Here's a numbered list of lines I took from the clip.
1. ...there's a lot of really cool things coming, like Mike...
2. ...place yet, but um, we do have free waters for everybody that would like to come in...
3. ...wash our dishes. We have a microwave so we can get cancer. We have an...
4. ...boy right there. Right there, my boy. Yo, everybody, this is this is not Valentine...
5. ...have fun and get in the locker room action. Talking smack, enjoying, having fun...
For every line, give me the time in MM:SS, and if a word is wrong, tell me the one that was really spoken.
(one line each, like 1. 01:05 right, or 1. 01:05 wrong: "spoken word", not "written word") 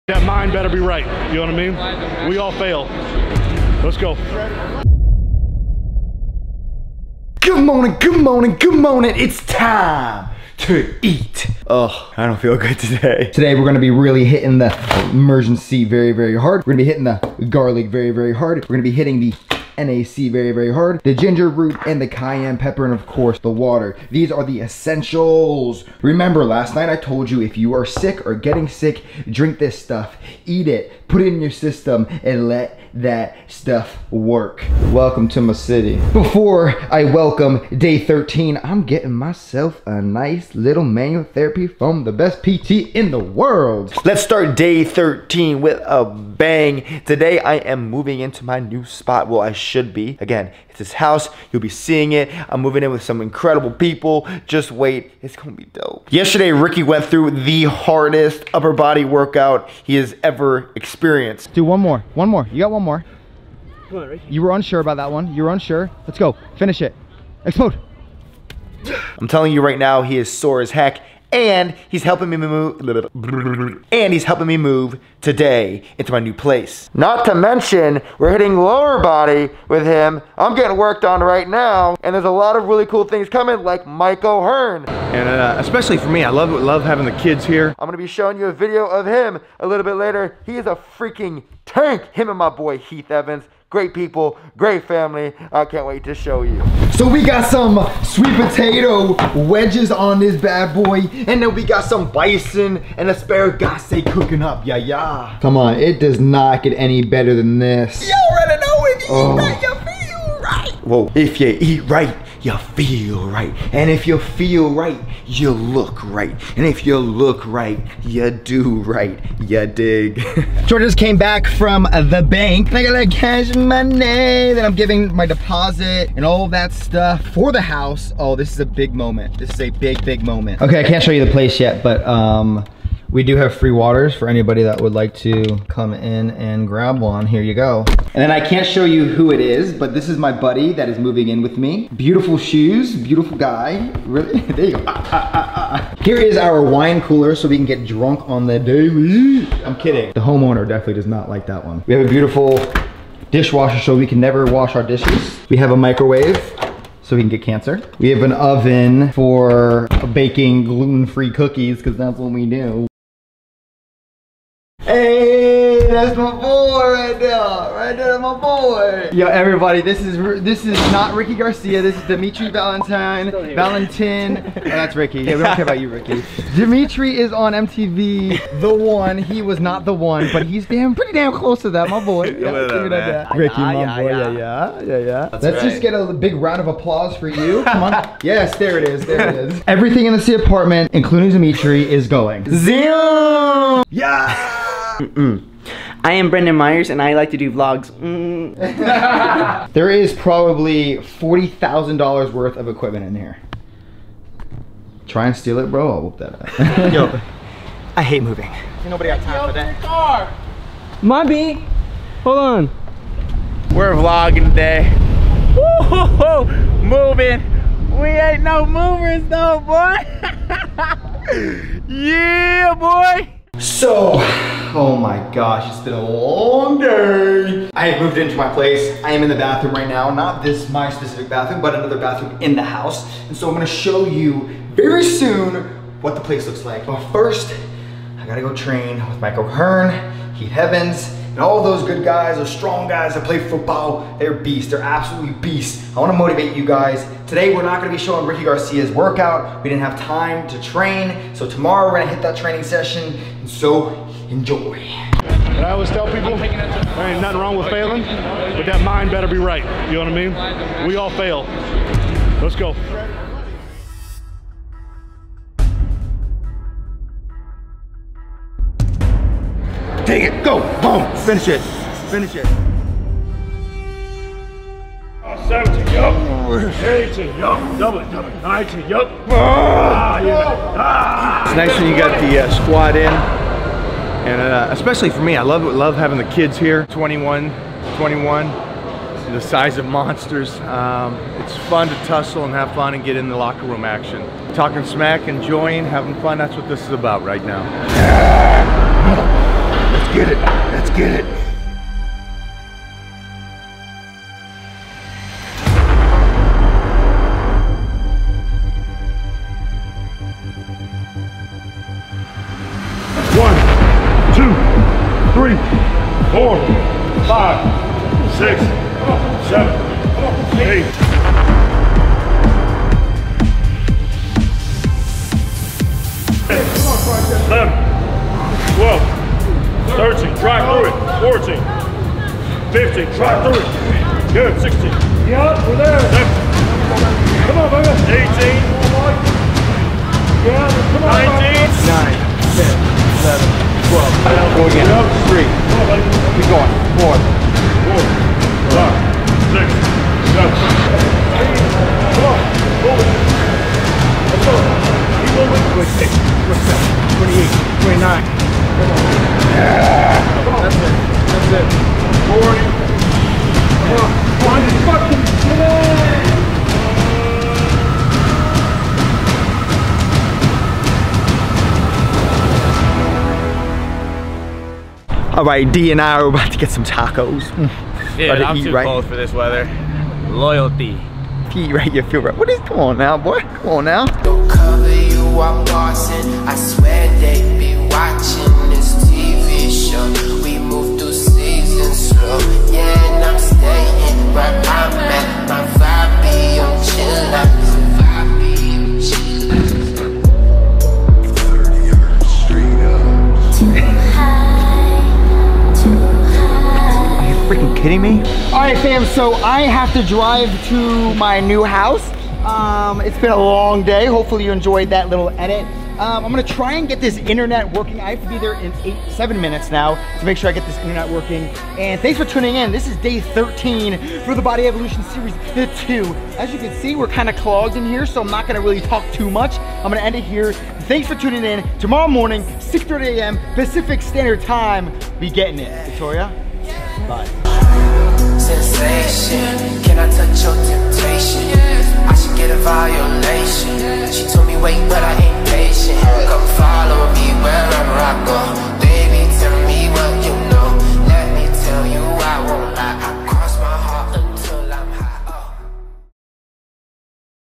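1. 01:22 right
2. 02:11 wrong: "anybody", not "everybody"
3. 02:34 right
4. 02:46 wrong: "Ricky", not "Valentine"
5. 04:52 right.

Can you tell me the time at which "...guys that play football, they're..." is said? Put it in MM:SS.
04:02.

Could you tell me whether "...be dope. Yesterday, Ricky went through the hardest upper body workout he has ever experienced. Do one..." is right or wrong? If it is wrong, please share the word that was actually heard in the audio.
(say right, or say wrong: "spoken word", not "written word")
right.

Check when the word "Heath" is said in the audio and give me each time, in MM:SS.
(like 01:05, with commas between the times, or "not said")
01:32, 04:00.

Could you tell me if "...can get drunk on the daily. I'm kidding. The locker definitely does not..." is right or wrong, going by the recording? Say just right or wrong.
wrong.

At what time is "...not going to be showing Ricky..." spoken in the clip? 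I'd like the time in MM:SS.
04:07.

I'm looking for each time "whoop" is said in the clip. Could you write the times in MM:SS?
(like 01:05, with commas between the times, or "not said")
03:26.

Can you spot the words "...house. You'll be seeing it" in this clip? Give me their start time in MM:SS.
00:50.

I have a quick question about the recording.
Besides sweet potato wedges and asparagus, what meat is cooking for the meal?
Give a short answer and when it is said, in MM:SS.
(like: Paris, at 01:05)
Bison, at 01:42.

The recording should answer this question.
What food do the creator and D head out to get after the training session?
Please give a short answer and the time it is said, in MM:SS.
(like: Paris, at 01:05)
Tacos, at 06:16.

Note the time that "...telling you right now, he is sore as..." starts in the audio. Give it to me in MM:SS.
01:09.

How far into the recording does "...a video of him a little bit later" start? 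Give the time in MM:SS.
01:28.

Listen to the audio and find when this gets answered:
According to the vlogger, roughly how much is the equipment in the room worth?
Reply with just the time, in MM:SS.
03:20.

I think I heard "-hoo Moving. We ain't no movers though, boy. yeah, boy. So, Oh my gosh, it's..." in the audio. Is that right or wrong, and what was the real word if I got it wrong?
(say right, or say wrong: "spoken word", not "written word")
right.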